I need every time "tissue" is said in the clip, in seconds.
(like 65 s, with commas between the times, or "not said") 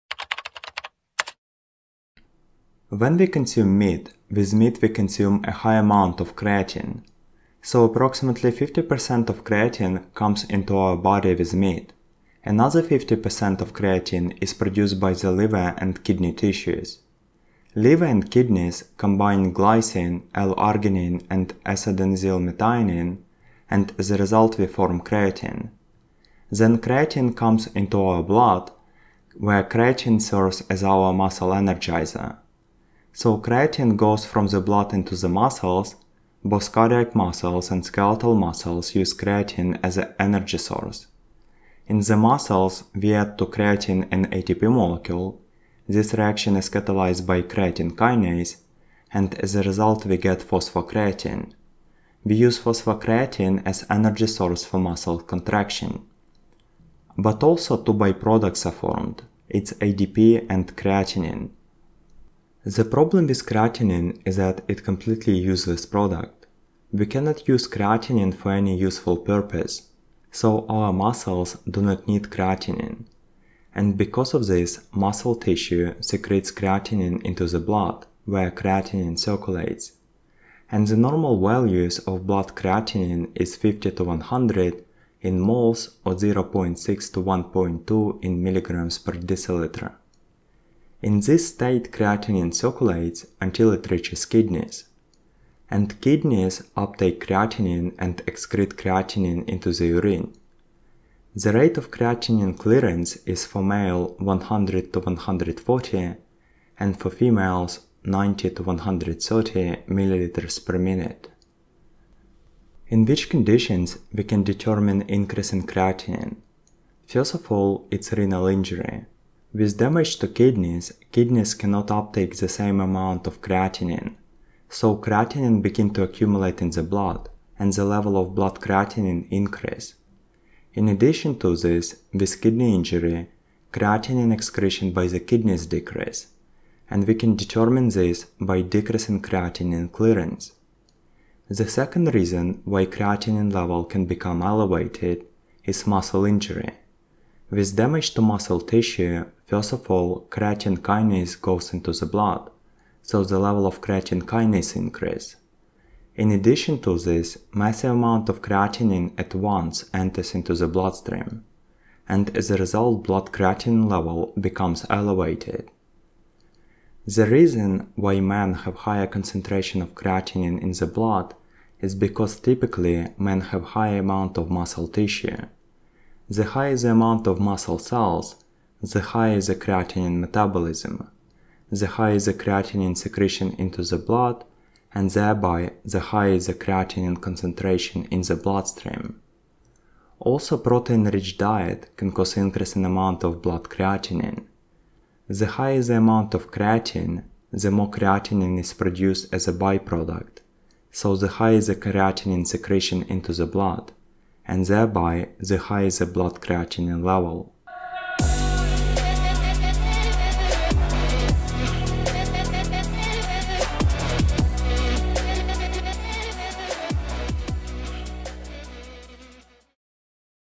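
16 s, 75 s, 148 s, 174 s.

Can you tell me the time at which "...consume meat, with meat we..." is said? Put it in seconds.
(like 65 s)
3 s.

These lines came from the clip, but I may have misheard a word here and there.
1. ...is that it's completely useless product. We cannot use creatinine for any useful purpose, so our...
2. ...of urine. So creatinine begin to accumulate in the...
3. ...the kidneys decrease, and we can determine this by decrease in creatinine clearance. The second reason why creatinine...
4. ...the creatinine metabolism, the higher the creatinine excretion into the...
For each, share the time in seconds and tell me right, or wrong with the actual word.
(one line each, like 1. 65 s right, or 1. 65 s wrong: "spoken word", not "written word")
1. 64 s right
2. 123 s wrong: "creatinine", not "urine"
3. 135 s right
4. 179 s wrong: "secretion", not "excretion".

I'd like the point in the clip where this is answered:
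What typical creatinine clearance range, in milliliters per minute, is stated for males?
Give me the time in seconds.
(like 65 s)
104 s.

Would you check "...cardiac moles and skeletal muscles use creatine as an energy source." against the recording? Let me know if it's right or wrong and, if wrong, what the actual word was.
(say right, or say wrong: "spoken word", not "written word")
wrong: "muscles", not "moles".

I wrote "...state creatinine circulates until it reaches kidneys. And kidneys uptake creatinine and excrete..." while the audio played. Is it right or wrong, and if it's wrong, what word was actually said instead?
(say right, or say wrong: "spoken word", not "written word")
right.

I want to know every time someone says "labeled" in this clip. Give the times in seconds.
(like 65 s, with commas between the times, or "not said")
not said.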